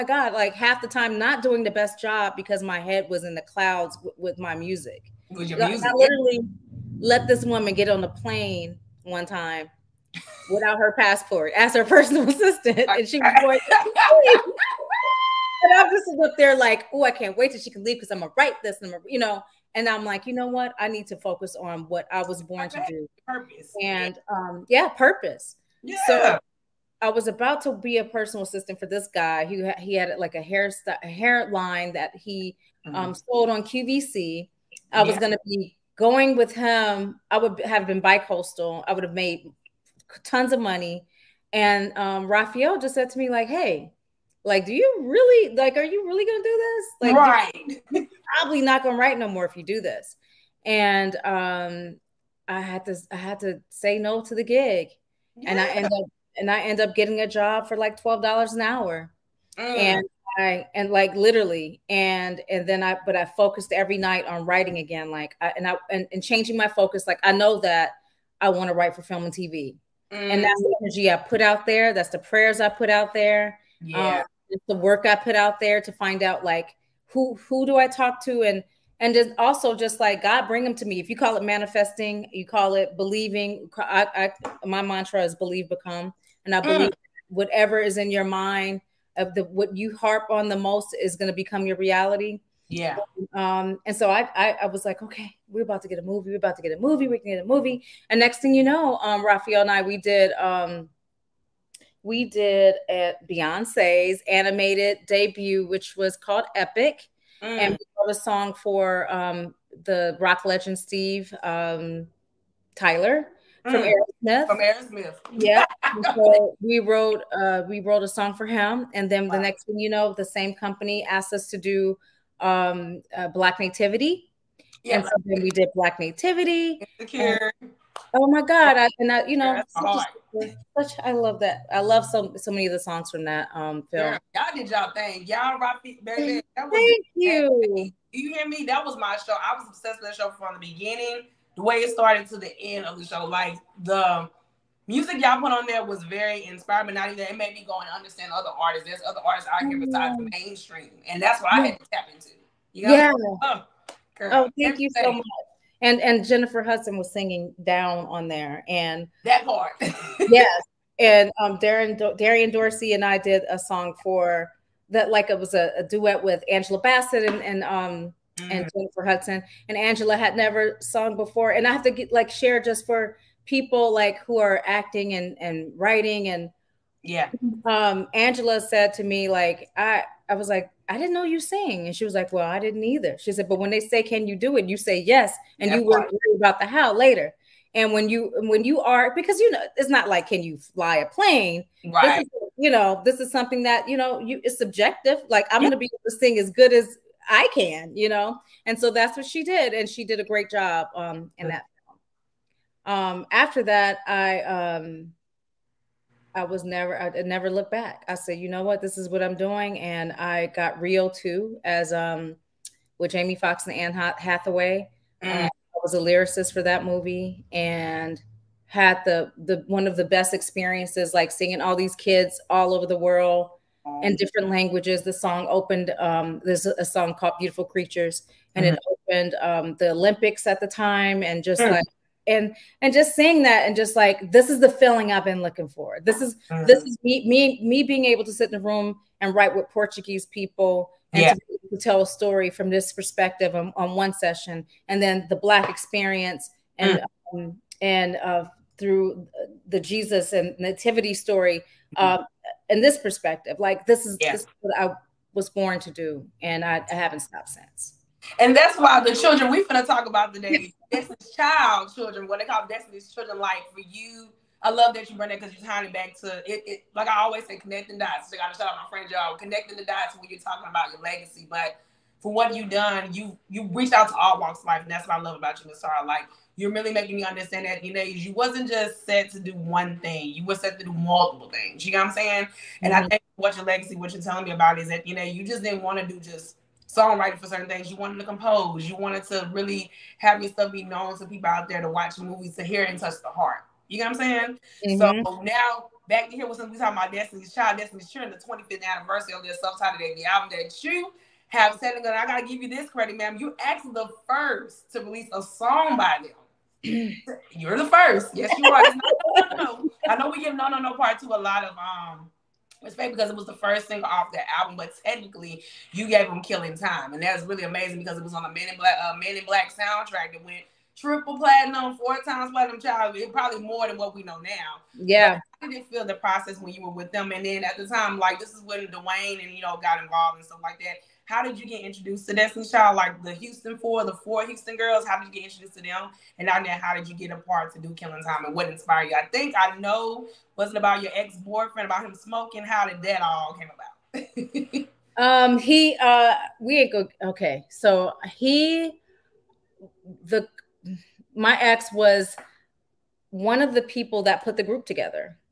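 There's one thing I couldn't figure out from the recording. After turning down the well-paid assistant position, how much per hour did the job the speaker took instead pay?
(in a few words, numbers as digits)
$12.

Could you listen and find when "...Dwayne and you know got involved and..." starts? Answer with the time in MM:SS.
05:28.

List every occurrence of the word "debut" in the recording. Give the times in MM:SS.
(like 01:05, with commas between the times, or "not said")
01:45, 04:59.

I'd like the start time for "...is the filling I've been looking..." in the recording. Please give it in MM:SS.
03:54.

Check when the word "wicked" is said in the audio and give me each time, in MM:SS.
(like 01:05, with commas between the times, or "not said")
not said.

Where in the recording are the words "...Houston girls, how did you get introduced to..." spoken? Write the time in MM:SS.
05:34.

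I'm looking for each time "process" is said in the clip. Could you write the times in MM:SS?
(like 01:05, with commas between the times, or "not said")
05:26.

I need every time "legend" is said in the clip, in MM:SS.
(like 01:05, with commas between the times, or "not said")
01:50.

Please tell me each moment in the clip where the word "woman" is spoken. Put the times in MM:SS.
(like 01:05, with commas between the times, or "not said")
00:07.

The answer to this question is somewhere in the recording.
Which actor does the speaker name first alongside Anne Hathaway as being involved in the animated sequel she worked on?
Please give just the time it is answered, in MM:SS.
03:33.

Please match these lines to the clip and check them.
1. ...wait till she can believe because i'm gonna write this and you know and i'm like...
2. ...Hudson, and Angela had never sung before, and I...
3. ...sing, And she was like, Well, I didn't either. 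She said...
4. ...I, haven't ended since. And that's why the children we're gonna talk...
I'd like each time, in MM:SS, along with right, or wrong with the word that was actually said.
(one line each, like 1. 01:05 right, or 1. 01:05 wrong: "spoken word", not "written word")
1. 00:17 wrong: "leave", not "believe"
2. 02:49 right
3. 03:01 right
4. 04:16 wrong: "stopped", not "ended".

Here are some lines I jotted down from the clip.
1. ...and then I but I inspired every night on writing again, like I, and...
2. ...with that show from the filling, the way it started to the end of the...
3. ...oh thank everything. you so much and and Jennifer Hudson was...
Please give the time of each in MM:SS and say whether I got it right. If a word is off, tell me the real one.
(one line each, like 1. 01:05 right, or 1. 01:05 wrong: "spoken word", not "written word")
1. 01:02 wrong: "focused", not "inspired"
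2. 02:20 wrong: "beginning", not "filling"
3. 02:34 right.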